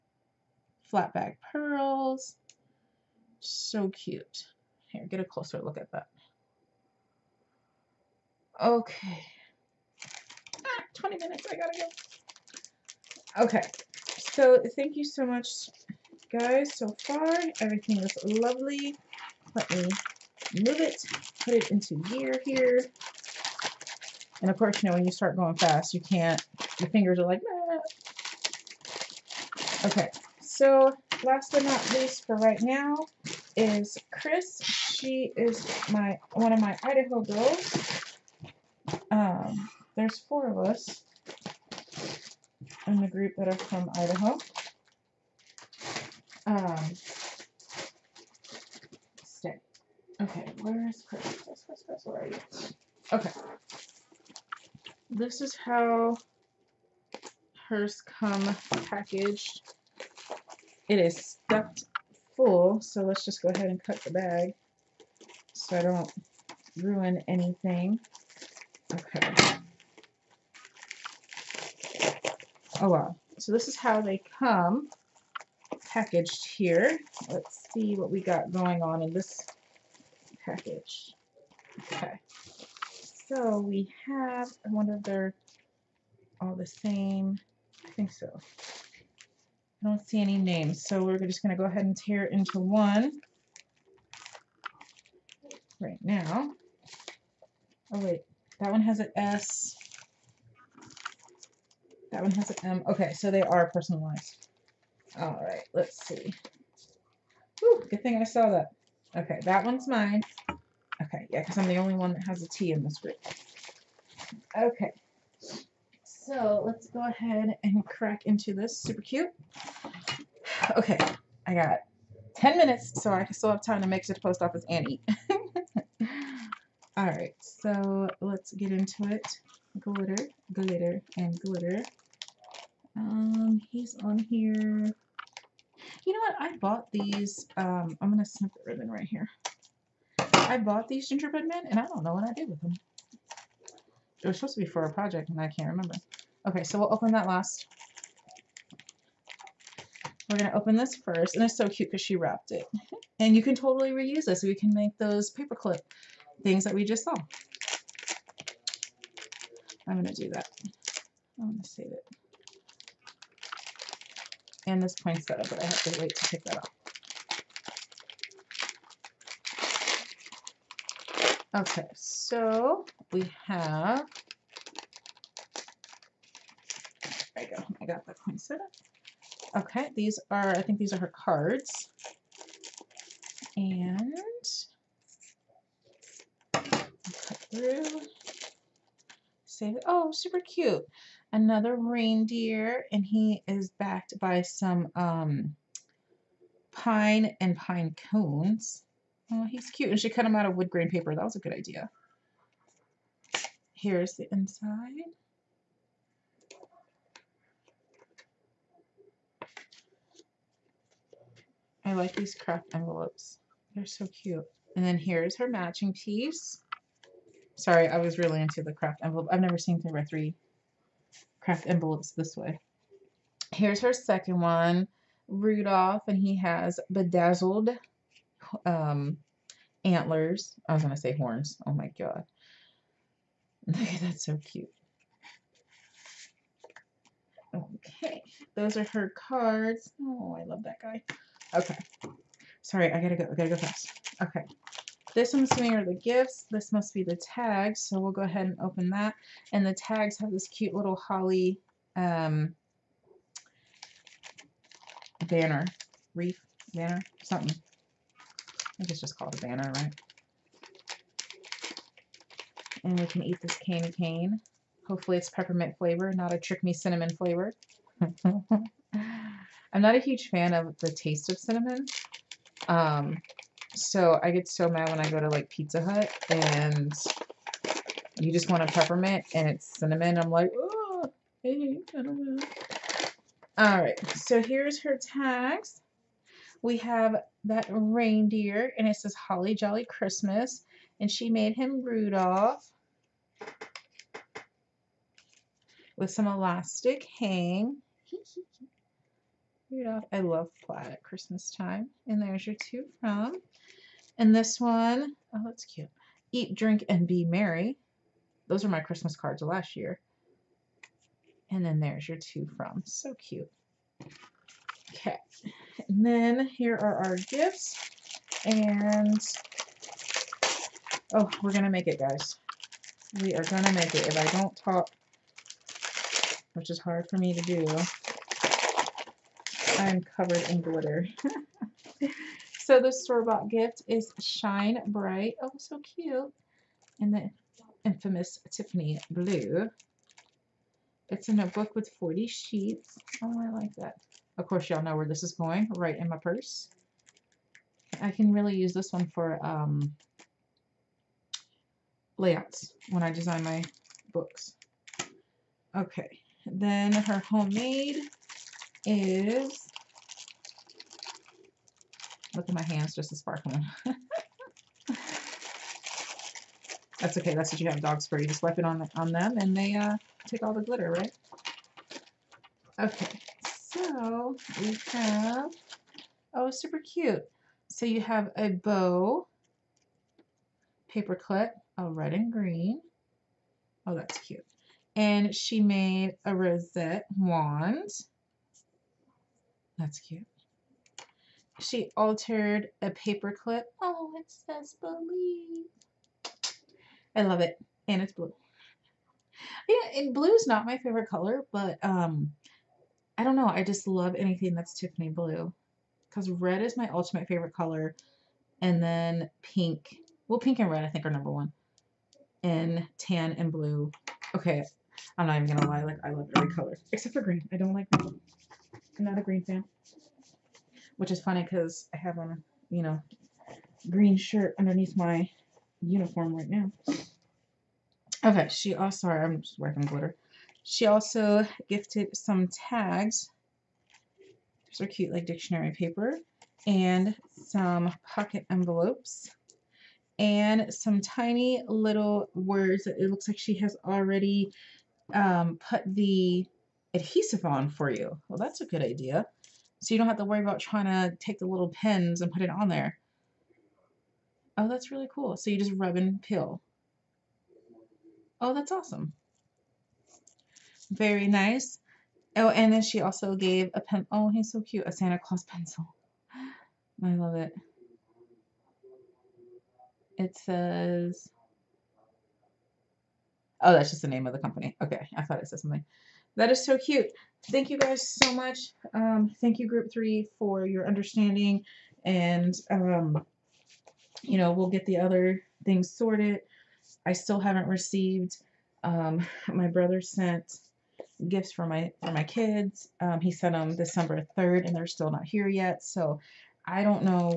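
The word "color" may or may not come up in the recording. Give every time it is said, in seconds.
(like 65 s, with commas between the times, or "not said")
401 s, 407 s, 416 s.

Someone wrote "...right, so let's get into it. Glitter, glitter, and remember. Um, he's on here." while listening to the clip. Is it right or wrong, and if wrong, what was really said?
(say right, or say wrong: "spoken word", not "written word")
wrong: "glitter", not "remember".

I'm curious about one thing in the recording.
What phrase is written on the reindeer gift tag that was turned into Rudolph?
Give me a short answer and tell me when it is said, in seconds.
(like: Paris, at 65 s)
Holly Jolly Christmas, at 289 s.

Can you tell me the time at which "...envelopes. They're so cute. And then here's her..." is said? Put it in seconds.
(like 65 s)
212 s.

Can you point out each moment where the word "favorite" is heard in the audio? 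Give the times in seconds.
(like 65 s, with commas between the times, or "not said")
400 s, 407 s.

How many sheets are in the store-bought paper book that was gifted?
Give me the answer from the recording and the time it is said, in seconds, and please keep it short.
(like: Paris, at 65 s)
40, at 341 s.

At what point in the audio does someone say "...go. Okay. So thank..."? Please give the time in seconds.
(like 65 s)
13 s.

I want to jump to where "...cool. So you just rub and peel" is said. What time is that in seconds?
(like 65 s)
455 s.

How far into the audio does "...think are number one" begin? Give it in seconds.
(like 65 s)
410 s.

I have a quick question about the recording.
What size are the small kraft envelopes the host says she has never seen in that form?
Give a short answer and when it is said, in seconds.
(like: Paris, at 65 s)
3 by 3, at 219 s.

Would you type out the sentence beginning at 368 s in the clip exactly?
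You just wipe it on, on them and they uh, take all the glitter, right?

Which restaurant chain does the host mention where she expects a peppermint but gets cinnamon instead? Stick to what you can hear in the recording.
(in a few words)
Pizza Hut.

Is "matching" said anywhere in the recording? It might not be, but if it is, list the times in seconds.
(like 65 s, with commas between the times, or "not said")
215 s.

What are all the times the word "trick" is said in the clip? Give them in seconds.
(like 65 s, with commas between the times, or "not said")
266 s.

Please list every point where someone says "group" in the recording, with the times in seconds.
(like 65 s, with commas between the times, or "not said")
43 s, 112 s, 479 s.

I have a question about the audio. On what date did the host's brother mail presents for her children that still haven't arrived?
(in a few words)
December 3.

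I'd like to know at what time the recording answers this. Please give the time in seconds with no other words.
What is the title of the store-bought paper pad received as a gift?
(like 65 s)
334 s.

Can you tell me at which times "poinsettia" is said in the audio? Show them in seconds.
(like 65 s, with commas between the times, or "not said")
164 s, 178 s.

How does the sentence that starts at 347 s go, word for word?
I can really use this one for um, layouts when I design my books.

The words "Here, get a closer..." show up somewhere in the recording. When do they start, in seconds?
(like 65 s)
4 s.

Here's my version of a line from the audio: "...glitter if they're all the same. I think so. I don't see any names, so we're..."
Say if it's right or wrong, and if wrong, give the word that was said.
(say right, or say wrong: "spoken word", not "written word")
wrong: "wonder", not "glitter".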